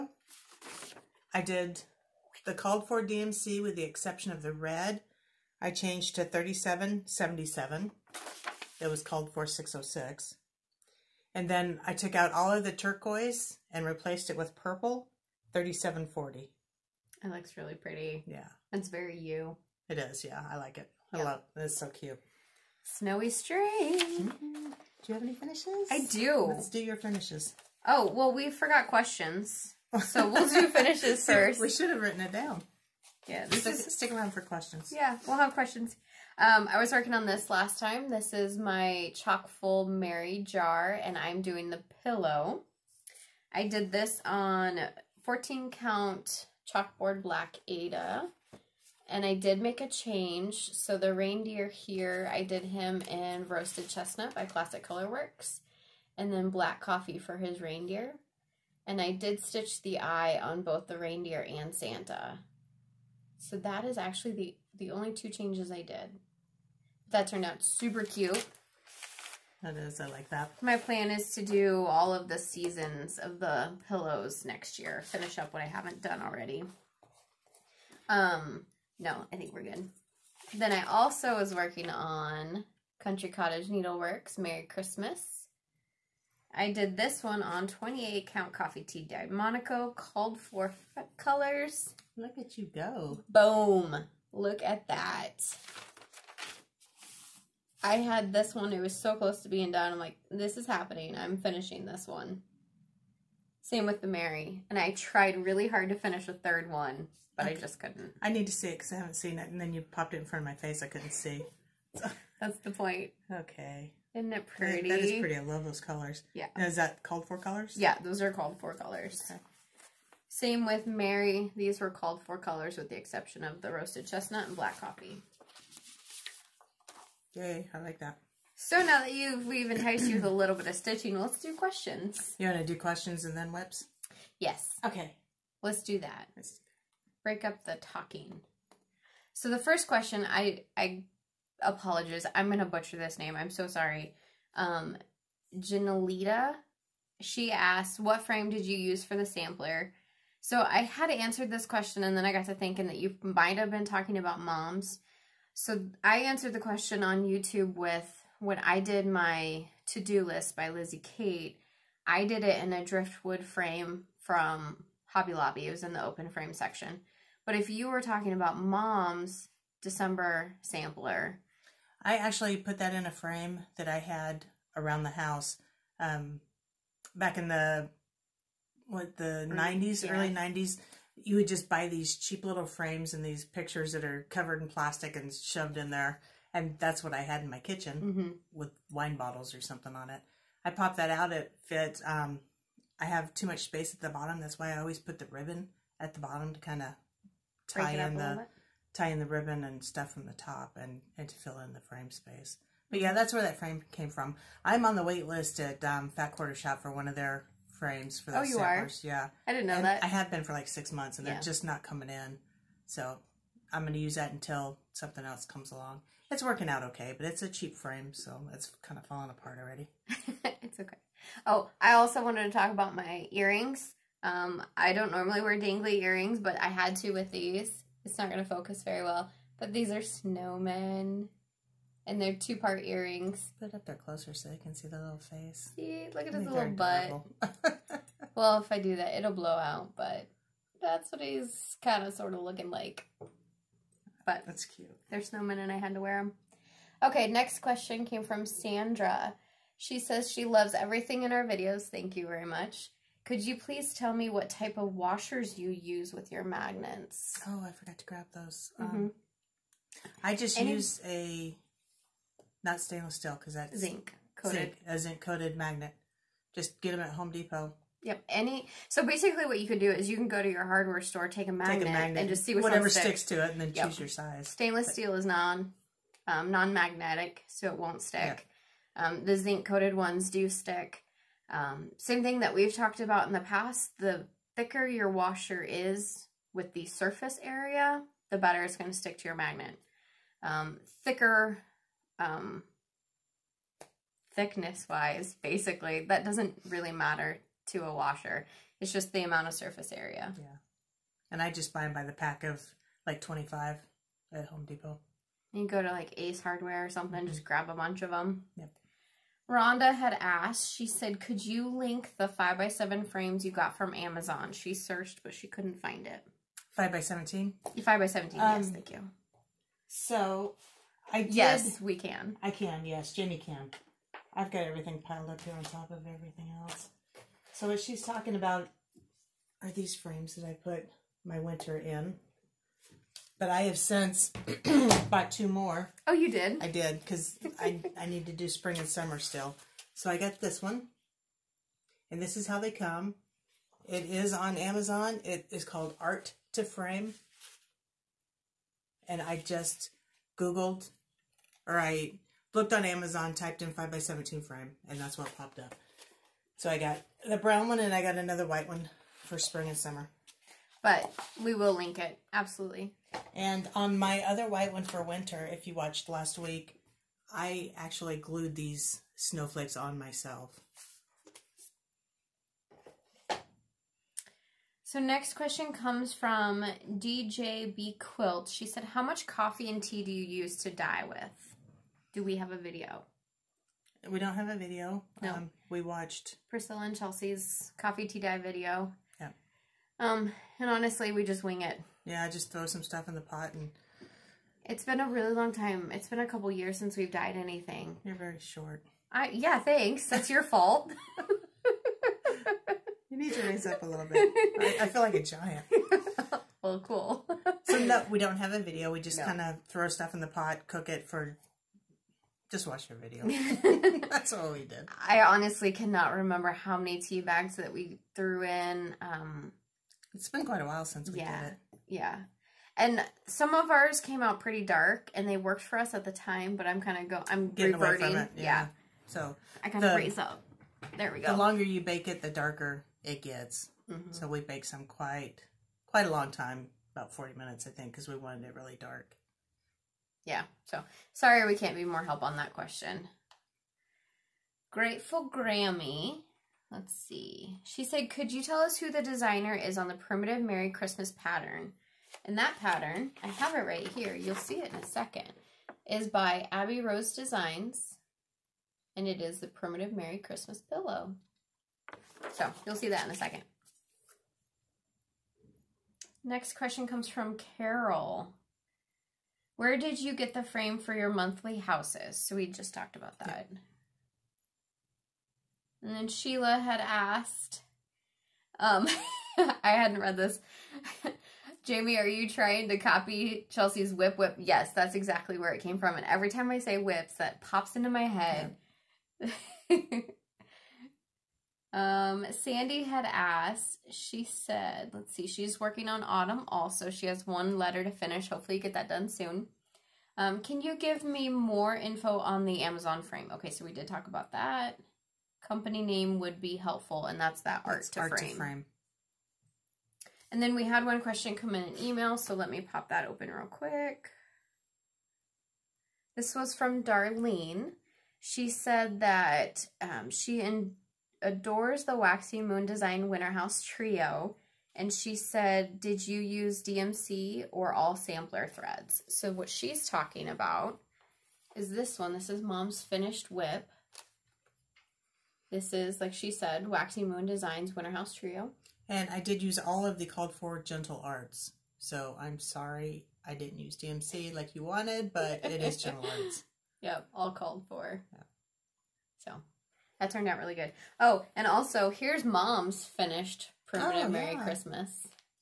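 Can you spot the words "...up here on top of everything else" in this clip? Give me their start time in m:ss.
5:25.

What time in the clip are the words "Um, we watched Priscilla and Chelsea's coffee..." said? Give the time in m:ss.
6:25.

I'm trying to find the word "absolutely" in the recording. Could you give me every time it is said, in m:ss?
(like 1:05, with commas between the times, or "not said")
6:02.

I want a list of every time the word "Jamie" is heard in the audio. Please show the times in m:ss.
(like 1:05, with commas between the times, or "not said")
8:01.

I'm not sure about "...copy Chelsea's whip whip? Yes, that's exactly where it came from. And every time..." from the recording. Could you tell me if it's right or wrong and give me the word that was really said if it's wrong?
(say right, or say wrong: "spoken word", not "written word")
right.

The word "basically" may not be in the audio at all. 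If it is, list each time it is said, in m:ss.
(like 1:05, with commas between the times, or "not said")
4:29, 4:55.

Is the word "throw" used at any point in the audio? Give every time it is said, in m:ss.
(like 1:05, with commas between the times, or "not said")
6:32, 6:49.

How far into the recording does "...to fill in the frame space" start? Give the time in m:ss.
3:21.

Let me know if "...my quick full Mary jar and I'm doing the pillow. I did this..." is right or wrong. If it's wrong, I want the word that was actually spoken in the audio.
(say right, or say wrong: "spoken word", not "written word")
wrong: "chock", not "quick".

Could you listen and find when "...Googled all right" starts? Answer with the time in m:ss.
5:50.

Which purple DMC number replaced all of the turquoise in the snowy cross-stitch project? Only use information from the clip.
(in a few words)
3740.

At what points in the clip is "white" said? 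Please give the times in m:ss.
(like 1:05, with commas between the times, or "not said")
5:58, 6:04.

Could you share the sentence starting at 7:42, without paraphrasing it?
So you'll see that in a second.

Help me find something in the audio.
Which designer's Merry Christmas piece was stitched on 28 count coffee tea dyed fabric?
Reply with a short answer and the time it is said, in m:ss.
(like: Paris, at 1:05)
Country Cottage Needleworks, at 1:23.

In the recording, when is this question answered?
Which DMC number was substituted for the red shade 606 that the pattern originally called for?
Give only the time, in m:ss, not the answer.
0:06.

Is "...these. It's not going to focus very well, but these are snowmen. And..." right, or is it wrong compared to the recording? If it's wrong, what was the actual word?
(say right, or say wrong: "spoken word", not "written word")
right.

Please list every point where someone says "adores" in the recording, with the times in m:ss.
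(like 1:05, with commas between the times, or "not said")
8:41.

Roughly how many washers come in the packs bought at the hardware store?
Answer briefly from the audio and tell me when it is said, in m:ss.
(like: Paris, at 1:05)
25, at 5:03.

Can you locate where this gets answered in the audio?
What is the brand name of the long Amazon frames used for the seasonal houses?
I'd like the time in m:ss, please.
5:45.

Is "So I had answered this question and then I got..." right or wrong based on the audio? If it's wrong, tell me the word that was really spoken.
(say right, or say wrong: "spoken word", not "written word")
right.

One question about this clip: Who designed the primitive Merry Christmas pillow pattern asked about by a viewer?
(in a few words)
Abby Rose Designs.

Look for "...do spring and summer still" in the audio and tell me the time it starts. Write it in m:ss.
5:38.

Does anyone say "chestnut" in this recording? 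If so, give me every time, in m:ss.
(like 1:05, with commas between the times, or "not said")
0:53, 2:04.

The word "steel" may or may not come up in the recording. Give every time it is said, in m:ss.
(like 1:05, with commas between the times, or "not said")
4:23, 4:34.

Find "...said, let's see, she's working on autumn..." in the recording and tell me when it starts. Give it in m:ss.
8:14.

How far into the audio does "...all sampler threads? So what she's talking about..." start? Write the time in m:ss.
8:47.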